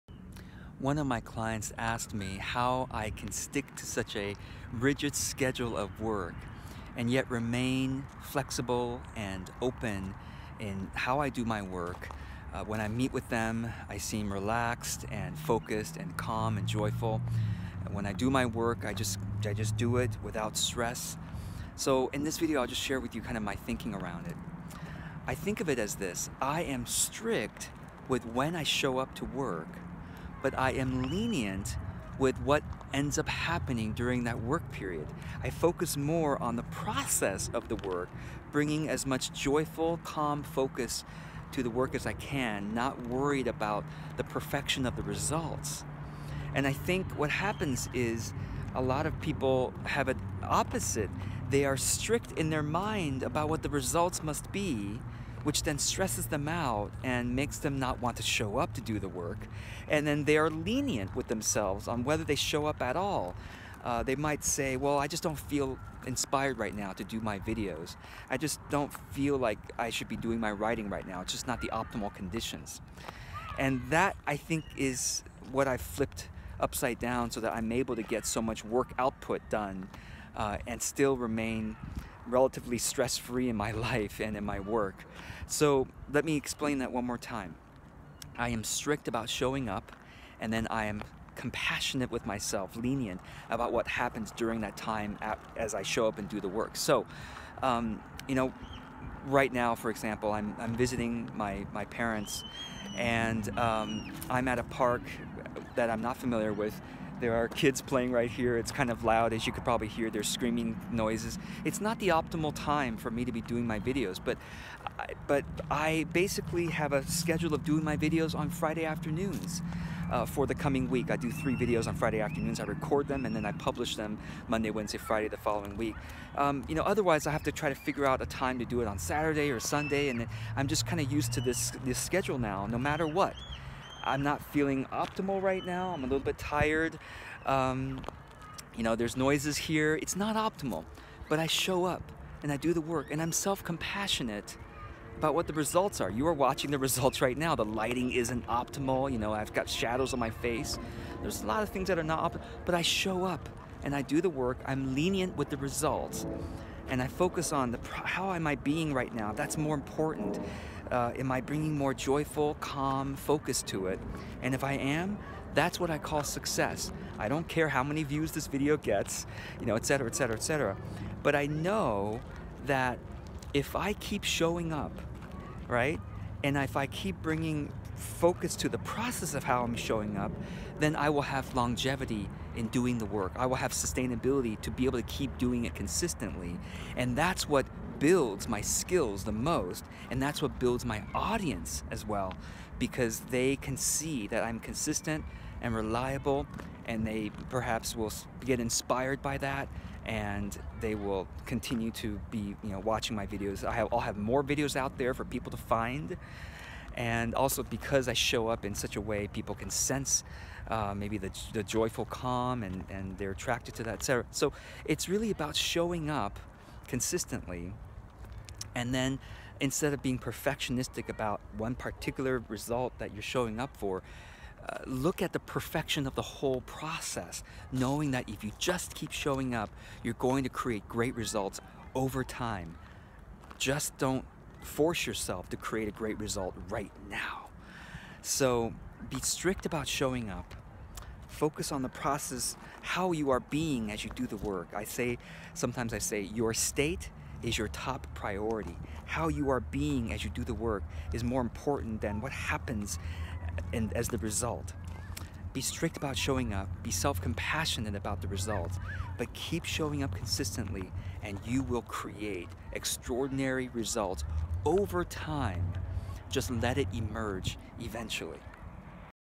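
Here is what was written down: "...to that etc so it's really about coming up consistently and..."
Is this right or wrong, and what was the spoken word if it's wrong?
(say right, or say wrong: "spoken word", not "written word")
wrong: "showing", not "coming".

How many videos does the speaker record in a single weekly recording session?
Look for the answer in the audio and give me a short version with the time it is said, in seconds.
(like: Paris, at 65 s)
3, at 121 s.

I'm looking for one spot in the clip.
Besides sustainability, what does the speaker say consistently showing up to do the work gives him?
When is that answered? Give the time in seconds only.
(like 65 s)
181 s.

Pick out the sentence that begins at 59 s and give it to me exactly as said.
And then they are lenient with themselves on whether they show up at all.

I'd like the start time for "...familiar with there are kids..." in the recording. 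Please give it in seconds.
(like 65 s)
106 s.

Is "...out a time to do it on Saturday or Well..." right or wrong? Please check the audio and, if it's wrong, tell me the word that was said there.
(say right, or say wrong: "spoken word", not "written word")
wrong: "Sunday", not "Well".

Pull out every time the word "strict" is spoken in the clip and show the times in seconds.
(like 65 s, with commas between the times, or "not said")
26 s, 51 s, 88 s, 239 s, 255 s.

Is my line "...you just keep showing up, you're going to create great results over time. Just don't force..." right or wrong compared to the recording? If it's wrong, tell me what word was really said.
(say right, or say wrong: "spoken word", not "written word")
right.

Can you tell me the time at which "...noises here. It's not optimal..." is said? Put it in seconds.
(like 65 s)
139 s.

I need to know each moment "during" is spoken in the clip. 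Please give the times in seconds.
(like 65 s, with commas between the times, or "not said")
33 s, 94 s.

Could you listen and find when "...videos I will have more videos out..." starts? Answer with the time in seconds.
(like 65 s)
203 s.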